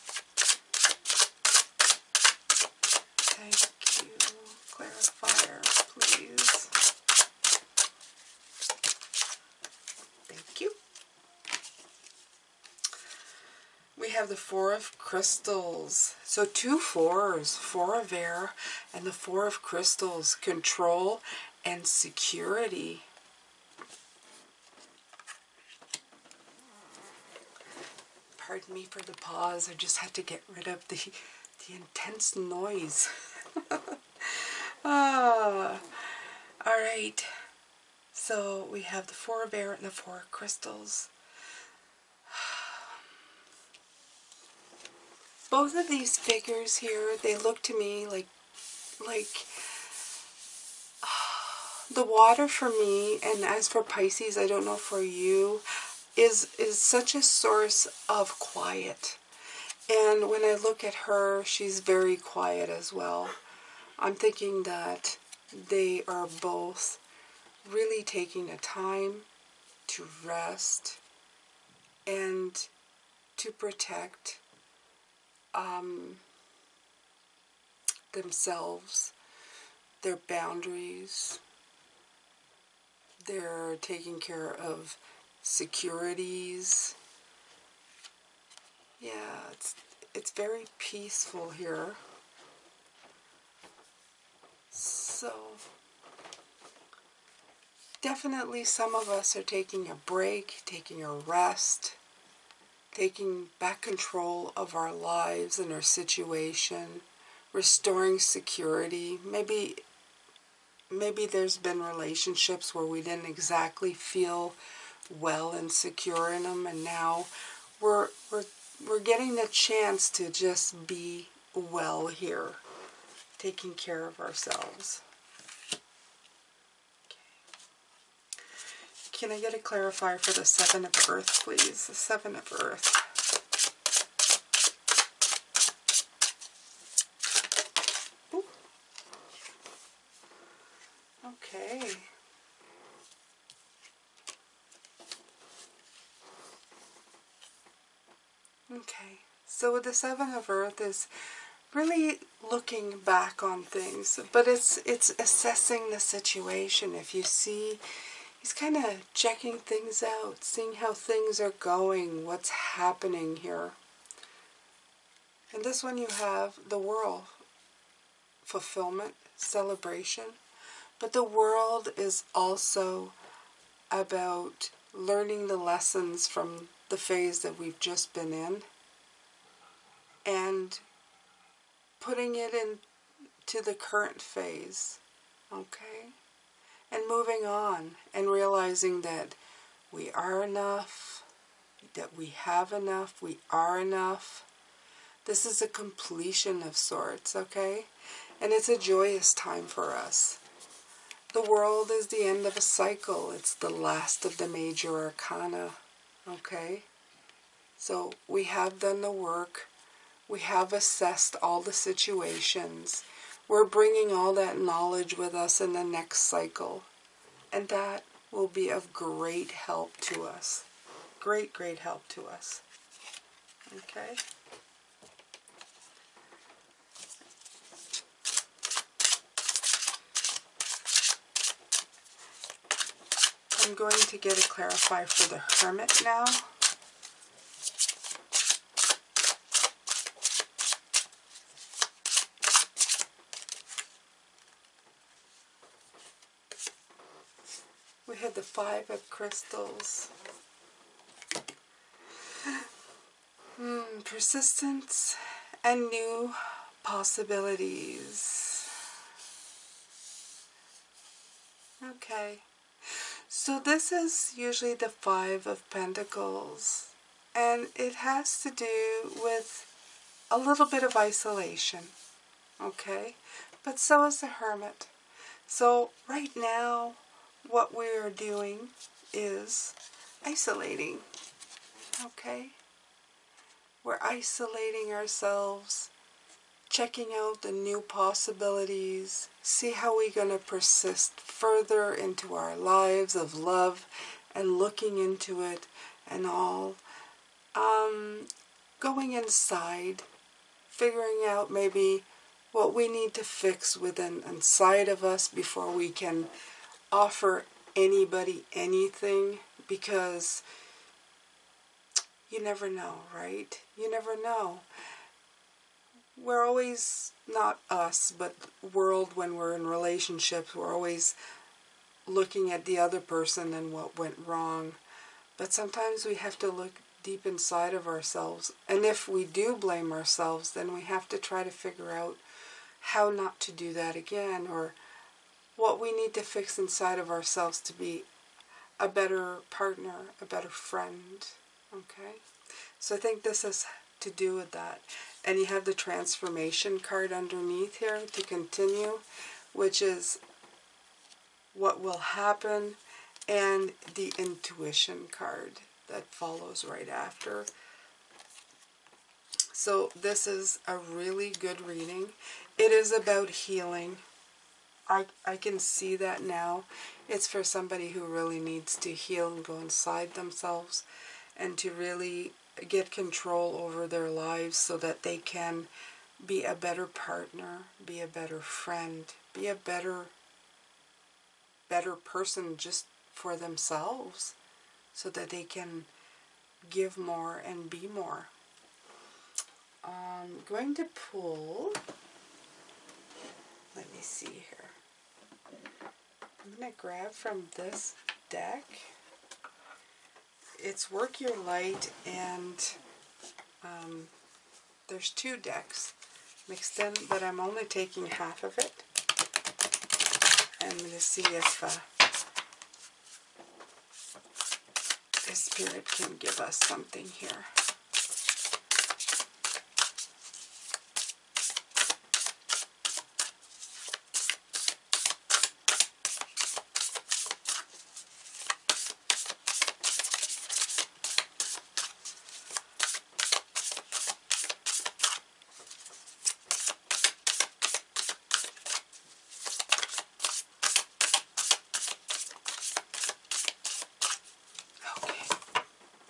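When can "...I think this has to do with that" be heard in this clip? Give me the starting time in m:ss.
5:42.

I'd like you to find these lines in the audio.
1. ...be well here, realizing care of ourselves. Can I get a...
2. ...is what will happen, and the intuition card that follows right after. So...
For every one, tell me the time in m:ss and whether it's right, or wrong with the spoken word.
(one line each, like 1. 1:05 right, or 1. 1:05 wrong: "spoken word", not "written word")
1. 2:00 wrong: "taking", not "realizing"
2. 5:49 right.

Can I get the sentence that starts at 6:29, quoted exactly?
I'm um, going to pull let me see here.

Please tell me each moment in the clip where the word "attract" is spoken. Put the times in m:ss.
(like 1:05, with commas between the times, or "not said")
not said.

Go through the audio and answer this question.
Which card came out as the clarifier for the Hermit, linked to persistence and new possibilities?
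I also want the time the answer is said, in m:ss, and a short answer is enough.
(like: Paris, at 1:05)
Five of Crystals, at 4:08.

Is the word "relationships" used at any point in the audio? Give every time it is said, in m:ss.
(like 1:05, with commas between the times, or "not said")
1:51, 5:19.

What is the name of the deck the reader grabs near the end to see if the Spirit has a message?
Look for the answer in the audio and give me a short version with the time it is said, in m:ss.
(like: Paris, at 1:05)
Work Your Light, at 6:40.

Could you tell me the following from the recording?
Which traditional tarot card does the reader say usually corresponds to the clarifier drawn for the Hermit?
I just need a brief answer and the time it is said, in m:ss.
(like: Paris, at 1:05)
Five of Pentacles, at 4:24.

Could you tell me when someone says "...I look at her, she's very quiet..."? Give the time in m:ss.
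1:00.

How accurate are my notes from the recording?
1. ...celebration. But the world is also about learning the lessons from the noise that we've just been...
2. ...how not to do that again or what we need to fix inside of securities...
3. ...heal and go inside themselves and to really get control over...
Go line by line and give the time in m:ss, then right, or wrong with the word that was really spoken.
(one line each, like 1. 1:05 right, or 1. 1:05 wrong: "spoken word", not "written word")
1. 2:49 wrong: "phase", not "noise"
2. 5:32 wrong: "ourselves", not "securities"
3. 6:08 right.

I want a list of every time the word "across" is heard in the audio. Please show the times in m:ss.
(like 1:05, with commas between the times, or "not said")
not said.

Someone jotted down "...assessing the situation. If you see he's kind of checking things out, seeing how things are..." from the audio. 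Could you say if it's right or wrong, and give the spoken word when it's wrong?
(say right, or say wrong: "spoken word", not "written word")
right.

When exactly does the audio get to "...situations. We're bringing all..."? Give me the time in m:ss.
3:31.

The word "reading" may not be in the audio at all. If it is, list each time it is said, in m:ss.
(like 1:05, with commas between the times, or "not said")
6:01.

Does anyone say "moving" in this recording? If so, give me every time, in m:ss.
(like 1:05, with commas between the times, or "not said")
3:07.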